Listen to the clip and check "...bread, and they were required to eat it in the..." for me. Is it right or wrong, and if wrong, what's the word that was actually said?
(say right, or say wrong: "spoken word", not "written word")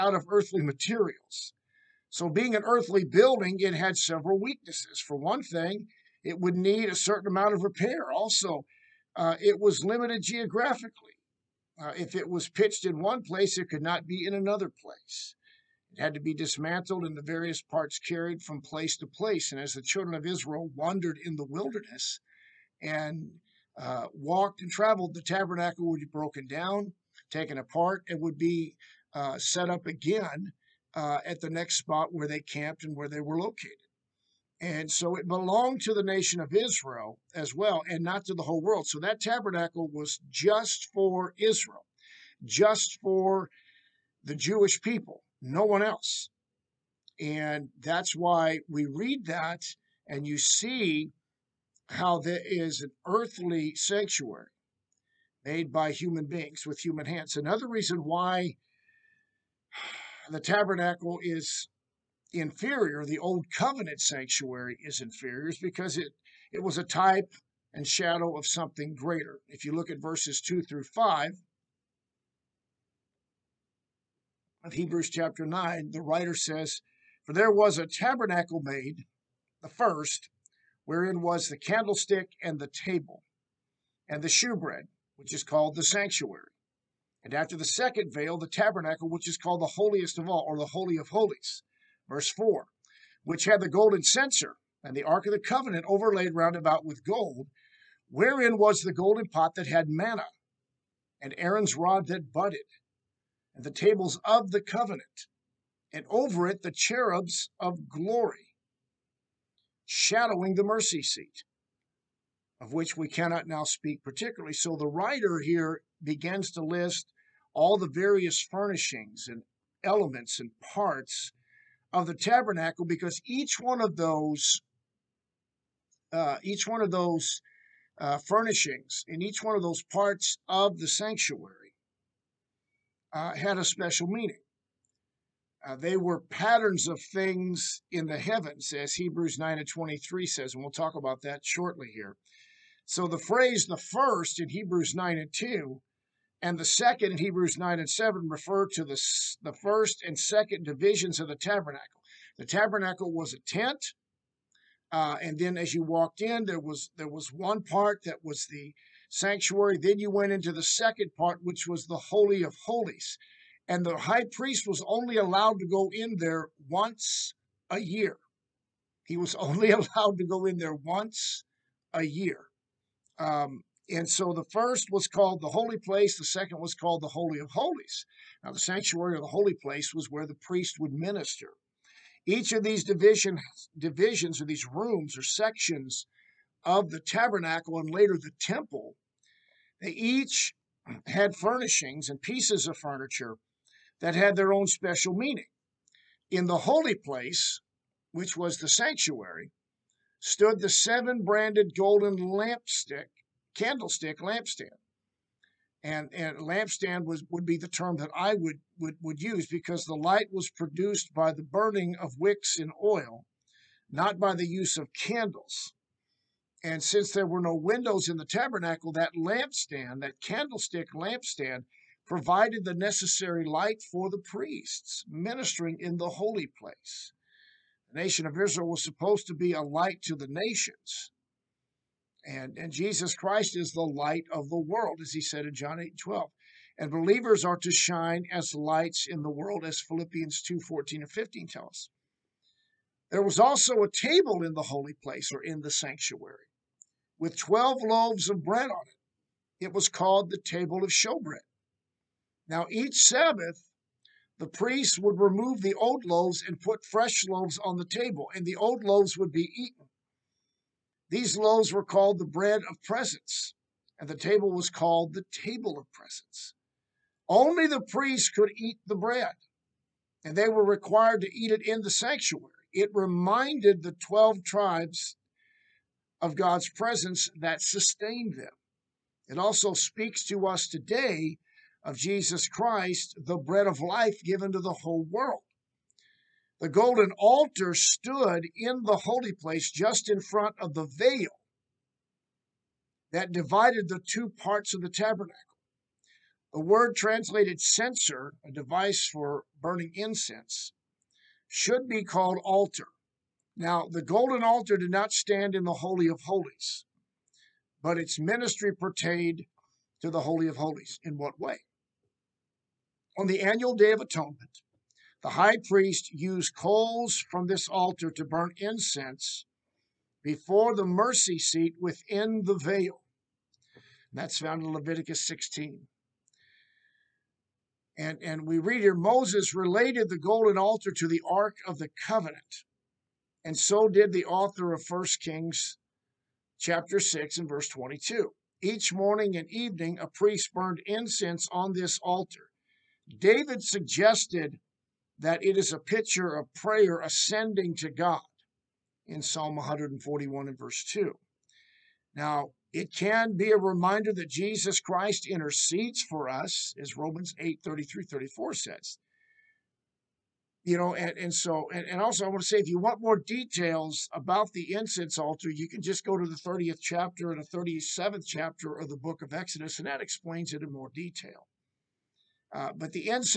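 right.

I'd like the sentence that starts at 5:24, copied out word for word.
And that's found in Leviticus 16.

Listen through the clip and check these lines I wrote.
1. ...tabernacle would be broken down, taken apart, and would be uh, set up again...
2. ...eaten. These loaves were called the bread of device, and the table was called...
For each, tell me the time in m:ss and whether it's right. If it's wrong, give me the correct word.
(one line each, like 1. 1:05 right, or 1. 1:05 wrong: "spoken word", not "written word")
1. 0:25 right
2. 4:19 wrong: "presence", not "device".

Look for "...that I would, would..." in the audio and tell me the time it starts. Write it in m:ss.
3:27.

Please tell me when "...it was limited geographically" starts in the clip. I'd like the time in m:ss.
0:09.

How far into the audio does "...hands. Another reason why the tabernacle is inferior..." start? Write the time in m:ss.
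0:57.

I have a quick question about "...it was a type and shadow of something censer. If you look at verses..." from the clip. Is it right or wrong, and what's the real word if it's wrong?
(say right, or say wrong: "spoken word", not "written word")
wrong: "greater", not "censer".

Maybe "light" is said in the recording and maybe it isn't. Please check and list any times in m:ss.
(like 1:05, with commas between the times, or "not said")
3:29, 3:43, 3:49, 3:53, 3:58.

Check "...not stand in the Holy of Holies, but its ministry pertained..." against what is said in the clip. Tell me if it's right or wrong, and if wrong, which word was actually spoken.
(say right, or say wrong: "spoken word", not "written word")
right.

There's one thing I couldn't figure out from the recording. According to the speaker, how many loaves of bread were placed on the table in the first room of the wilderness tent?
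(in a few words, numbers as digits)
12.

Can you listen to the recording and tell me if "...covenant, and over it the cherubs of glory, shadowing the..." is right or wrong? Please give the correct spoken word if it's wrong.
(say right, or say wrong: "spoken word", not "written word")
right.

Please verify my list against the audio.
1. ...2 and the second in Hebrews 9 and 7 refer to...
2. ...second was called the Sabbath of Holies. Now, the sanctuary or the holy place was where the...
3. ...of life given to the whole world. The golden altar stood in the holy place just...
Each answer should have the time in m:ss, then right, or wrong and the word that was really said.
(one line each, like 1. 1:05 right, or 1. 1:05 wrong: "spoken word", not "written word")
1. 2:25 right
2. 2:56 wrong: "Holy", not "Sabbath"
3. 4:43 right.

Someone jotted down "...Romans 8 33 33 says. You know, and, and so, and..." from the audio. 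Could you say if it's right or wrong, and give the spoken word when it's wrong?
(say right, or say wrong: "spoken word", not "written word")
wrong: "34", not "33".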